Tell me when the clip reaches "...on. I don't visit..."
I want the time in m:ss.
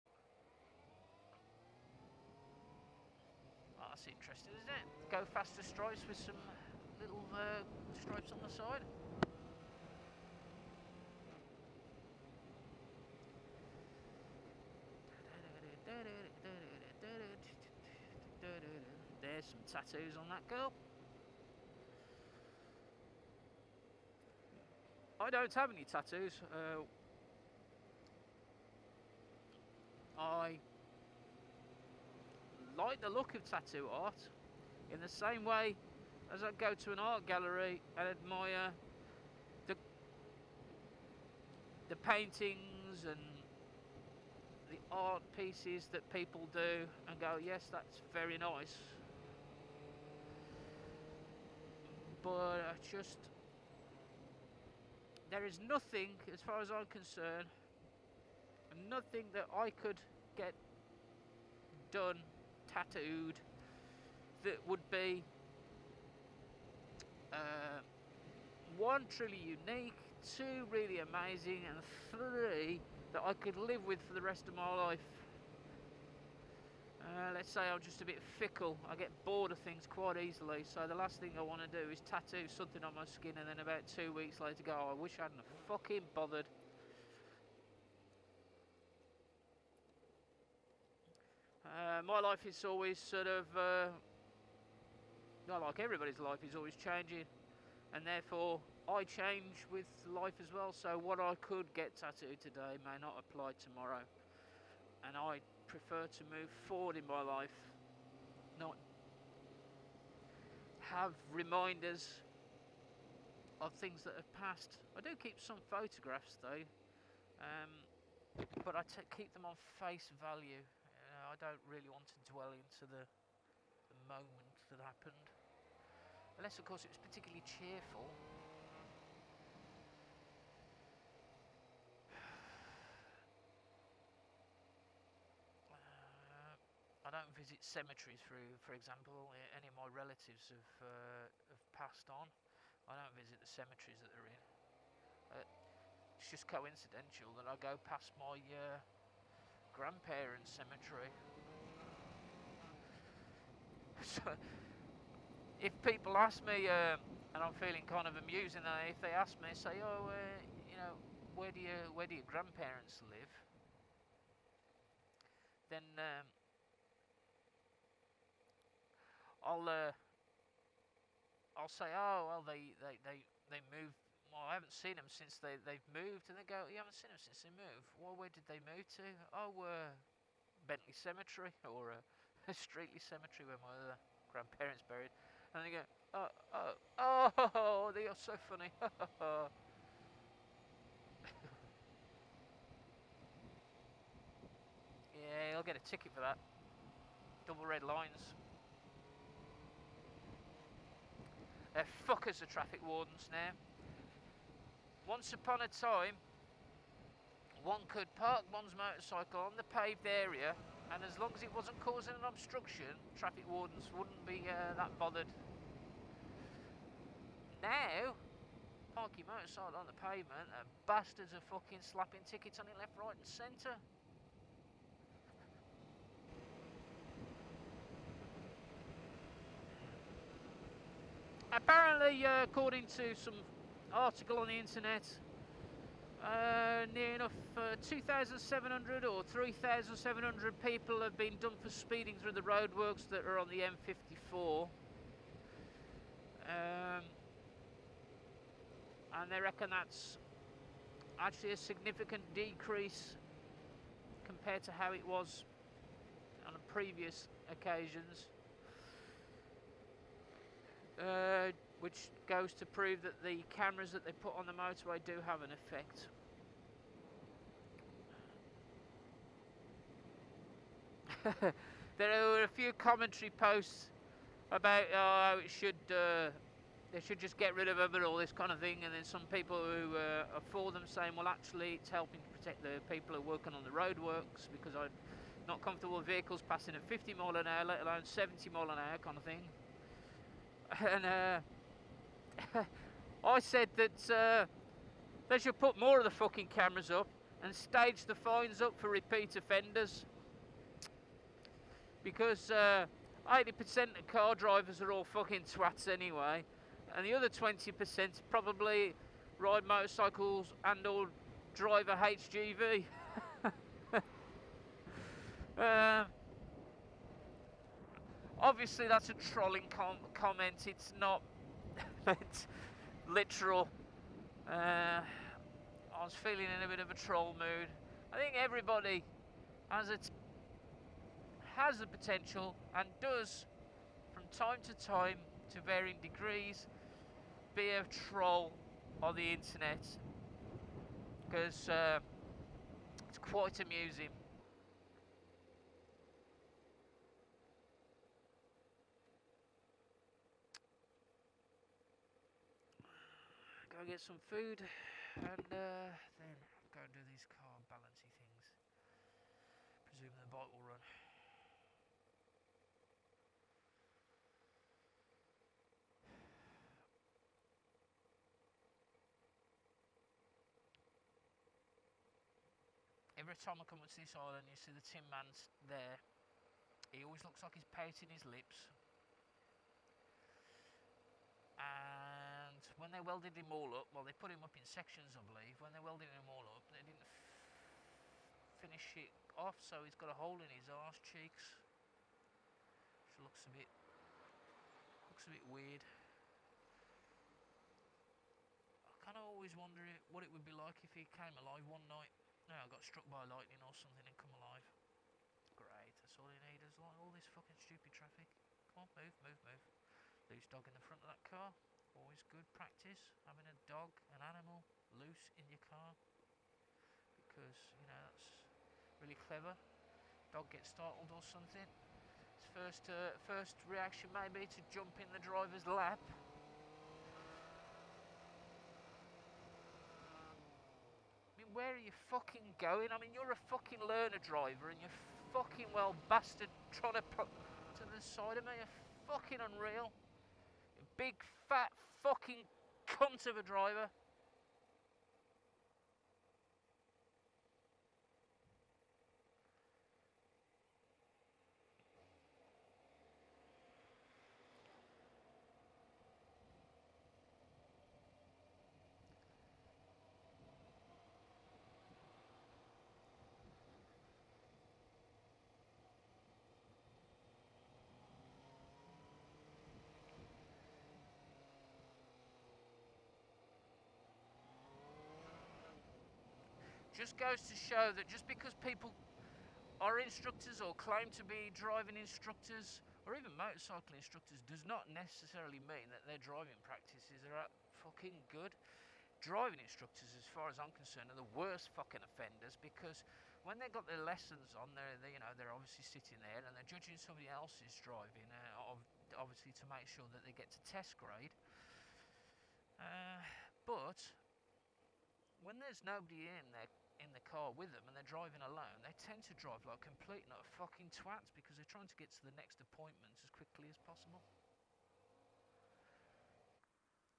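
2:22.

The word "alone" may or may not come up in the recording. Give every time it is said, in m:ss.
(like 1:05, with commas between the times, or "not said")
4:47, 8:28.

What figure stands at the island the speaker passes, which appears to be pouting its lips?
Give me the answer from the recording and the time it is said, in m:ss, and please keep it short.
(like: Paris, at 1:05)
the tin man, at 6:14.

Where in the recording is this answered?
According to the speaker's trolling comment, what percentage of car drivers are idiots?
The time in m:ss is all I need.
5:03.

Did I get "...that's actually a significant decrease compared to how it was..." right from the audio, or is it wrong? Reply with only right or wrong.
right.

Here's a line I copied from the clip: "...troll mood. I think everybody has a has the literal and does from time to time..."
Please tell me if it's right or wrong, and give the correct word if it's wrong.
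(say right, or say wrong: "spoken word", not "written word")
wrong: "potential", not "literal".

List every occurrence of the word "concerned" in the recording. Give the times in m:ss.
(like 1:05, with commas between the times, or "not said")
0:56, 8:10.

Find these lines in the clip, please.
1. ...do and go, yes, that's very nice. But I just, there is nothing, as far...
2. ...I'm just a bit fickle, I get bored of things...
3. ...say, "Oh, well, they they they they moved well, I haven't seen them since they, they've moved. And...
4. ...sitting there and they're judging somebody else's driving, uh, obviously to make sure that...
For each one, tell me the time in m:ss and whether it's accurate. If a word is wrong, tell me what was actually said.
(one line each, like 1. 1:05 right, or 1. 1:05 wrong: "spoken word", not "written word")
1. 0:46 right
2. 1:17 right
3. 2:51 right
4. 8:15 right.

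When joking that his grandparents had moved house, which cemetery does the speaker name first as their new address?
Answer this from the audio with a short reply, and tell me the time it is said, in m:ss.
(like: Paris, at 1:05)
Bentley Cemetery, at 3:00.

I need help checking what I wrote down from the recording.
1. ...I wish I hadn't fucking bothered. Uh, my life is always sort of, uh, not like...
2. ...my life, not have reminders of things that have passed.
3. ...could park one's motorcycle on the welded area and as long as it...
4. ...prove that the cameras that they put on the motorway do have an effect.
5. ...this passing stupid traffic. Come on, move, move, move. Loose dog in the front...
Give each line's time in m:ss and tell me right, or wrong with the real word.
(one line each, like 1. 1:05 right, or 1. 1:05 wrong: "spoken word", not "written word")
1. 1:24 right
2. 1:47 right
3. 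3:27 wrong: "paved", not "welded"
4. 4:22 right
5. 6:47 wrong: "fucking", not "passing".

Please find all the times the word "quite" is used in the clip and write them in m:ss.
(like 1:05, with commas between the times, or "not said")
1:19, 5:43.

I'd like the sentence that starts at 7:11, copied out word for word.
I mean, where are you fucking going?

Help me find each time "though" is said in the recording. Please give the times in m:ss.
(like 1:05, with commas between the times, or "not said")
1:56.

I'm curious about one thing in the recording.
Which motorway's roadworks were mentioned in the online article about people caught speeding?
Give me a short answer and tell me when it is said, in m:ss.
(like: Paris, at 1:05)
M54, at 4:03.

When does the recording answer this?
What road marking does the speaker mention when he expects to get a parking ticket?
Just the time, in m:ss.
3:17.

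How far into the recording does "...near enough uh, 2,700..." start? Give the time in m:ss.
3:56.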